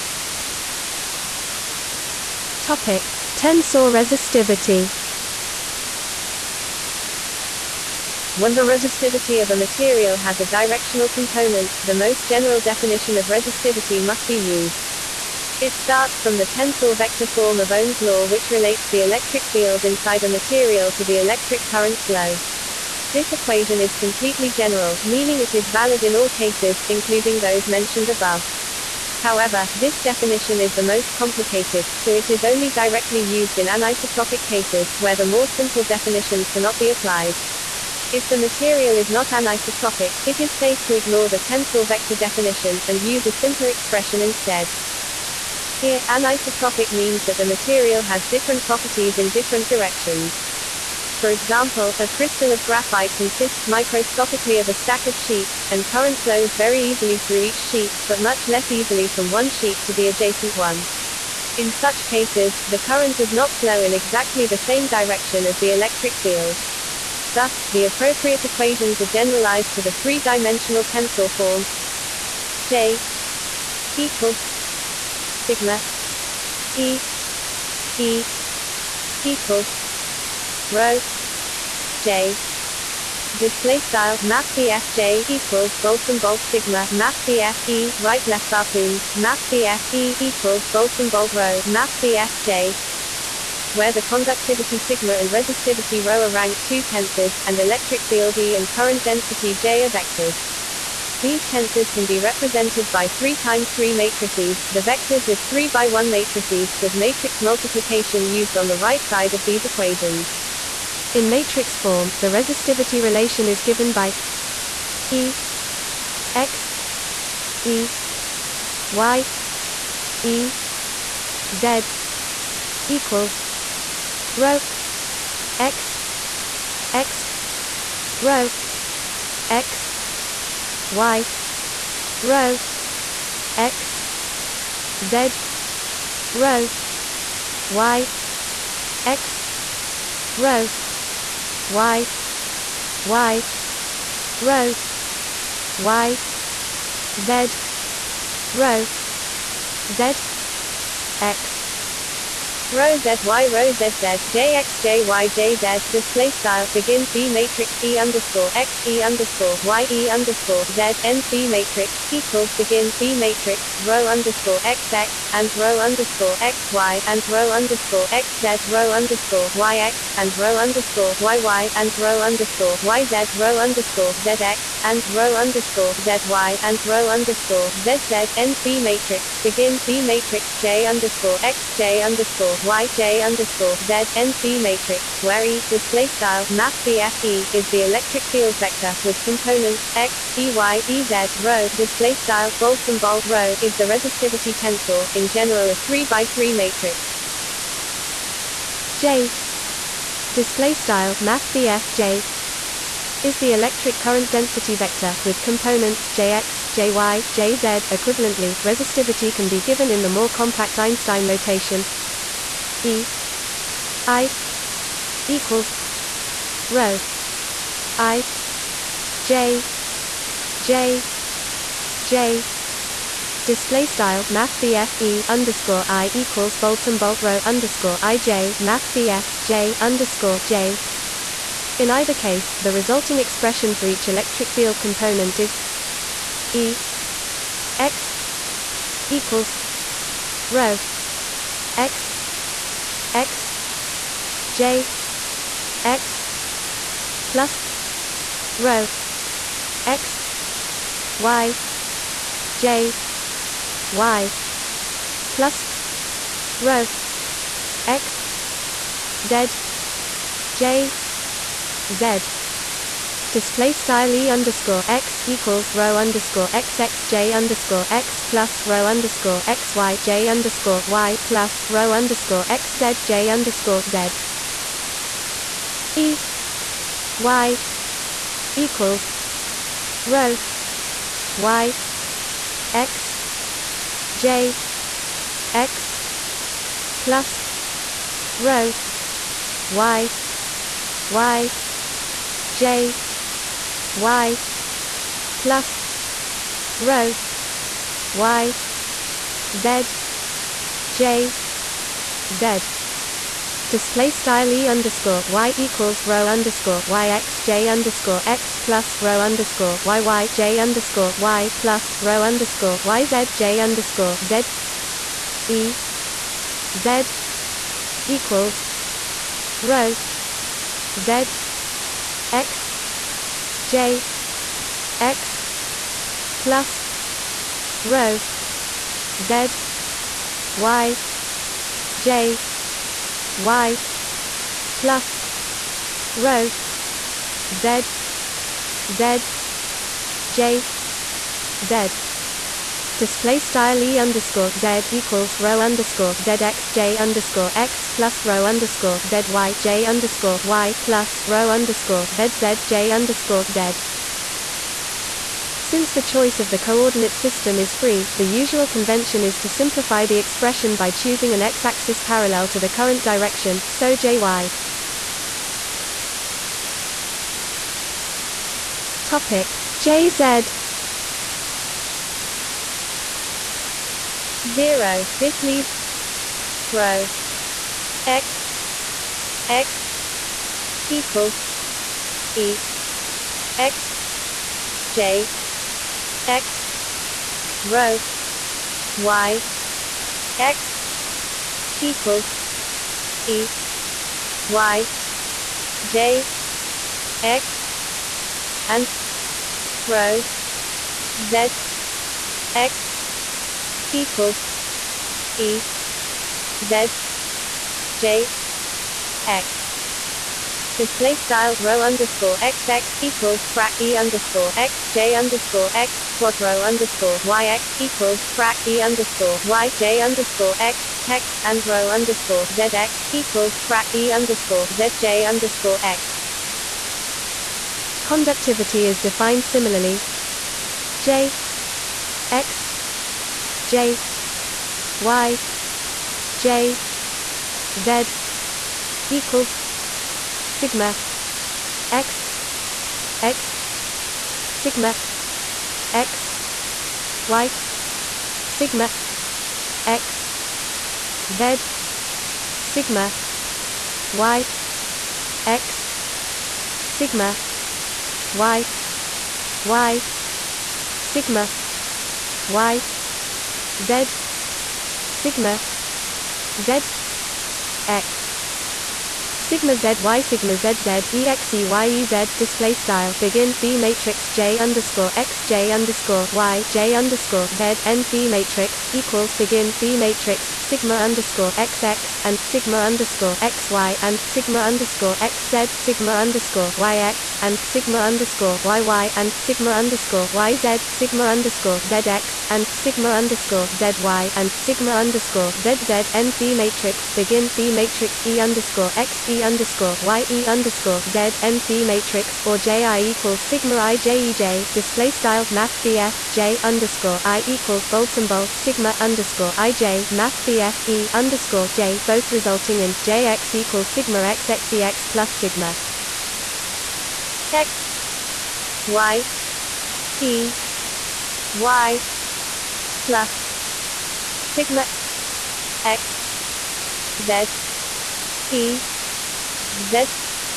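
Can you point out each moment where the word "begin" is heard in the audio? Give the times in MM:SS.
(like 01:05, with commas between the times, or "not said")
02:36, 02:42, 02:59, 07:53, 07:59, 08:17.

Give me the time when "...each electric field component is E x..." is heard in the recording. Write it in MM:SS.
03:53.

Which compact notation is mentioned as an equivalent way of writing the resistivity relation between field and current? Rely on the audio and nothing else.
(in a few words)
Einstein notation.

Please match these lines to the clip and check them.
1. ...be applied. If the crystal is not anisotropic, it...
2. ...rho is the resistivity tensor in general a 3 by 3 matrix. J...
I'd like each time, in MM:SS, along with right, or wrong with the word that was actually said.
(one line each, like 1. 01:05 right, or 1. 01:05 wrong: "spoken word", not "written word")
1. 00:36 wrong: "material", not "crystal"
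2. 03:13 right.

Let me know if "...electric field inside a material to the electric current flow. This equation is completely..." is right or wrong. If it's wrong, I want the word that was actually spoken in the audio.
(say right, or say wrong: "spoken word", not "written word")
right.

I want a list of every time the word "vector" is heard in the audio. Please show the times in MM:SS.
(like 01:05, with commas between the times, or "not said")
00:16, 00:41, 01:39, 01:44, 03:08, 03:24.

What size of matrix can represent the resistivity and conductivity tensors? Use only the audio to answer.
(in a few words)
3 by 3.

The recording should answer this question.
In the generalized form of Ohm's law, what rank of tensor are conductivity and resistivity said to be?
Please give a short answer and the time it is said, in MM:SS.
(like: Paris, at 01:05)
Rank 2, at 01:36.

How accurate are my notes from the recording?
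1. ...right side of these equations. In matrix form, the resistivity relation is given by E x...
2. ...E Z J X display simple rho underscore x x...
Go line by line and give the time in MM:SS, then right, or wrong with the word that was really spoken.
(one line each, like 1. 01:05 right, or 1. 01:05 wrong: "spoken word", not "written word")
1. 01:48 right
2. 06:45 wrong: "style", not "simple".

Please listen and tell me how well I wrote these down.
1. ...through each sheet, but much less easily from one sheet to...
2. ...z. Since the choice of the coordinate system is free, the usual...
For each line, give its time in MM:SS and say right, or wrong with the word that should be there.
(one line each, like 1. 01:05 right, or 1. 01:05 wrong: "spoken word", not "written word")
1. 00:57 right
2. 05:53 right.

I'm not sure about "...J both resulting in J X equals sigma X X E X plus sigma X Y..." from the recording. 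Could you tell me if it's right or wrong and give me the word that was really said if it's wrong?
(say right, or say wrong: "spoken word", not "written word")
right.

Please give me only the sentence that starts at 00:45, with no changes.
Here, anisotropic means that the material has different properties in different directions.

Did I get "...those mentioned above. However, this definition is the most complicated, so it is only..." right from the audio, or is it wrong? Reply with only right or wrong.
right.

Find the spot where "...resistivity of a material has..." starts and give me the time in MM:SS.
00:08.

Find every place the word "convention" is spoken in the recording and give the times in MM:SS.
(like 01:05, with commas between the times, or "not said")
05:58.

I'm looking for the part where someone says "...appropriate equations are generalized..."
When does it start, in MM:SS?
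01:07.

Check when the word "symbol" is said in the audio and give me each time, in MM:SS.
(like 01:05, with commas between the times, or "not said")
01:25, 01:30, 03:12, 08:28.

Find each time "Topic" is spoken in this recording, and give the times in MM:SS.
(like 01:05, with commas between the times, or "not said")
00:02, 06:09.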